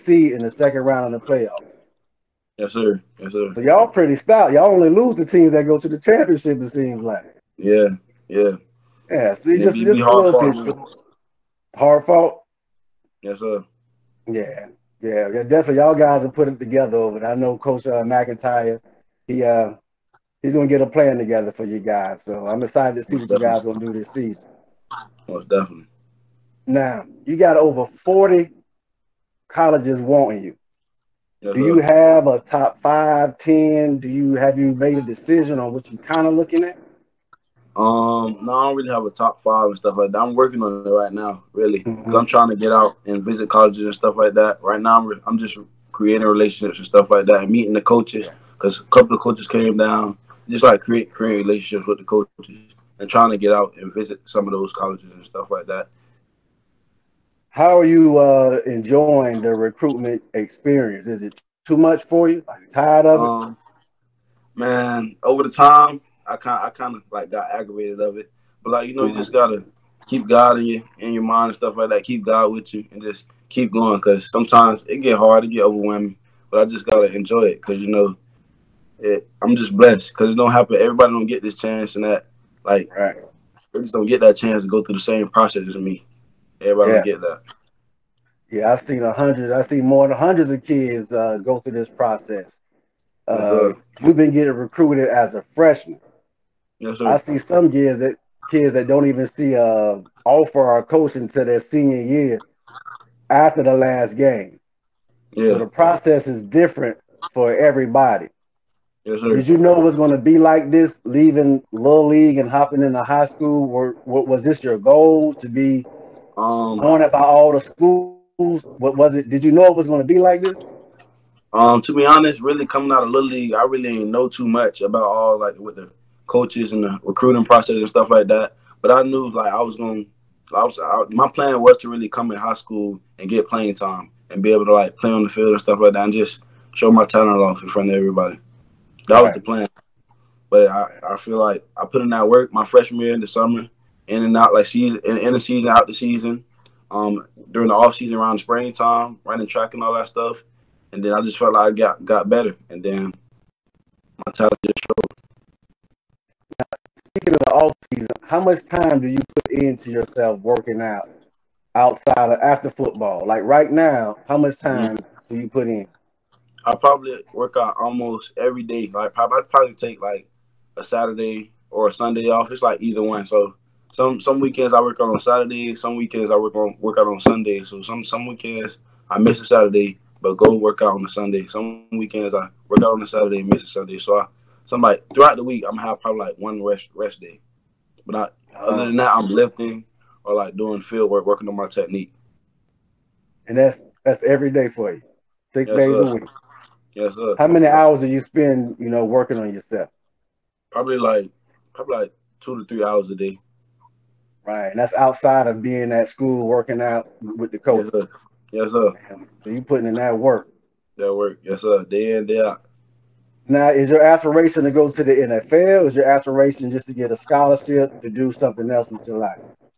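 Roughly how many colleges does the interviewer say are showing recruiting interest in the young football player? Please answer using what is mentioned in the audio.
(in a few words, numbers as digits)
over 40.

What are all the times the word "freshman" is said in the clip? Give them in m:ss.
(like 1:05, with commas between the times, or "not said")
1:35, 2:22.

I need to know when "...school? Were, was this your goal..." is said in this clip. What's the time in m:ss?
1:53.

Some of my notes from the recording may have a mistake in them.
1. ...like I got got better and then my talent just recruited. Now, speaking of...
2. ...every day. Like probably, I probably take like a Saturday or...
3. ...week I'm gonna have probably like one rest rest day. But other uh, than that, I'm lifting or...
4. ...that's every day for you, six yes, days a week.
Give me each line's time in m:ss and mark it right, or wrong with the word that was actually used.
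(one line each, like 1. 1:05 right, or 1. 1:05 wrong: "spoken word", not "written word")
1. 2:31 wrong: "showed", not "recruited"
2. 2:48 right
3. 3:05 right
4. 3:14 right.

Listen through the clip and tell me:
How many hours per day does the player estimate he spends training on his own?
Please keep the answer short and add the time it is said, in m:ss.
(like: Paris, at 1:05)
2 to 3 hours, at 3:22.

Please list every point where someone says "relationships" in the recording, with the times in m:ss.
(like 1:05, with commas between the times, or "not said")
0:46, 0:51.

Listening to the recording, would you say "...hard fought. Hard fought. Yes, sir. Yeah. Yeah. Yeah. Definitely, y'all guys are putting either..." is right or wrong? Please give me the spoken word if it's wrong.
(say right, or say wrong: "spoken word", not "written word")
wrong: "together", not "either".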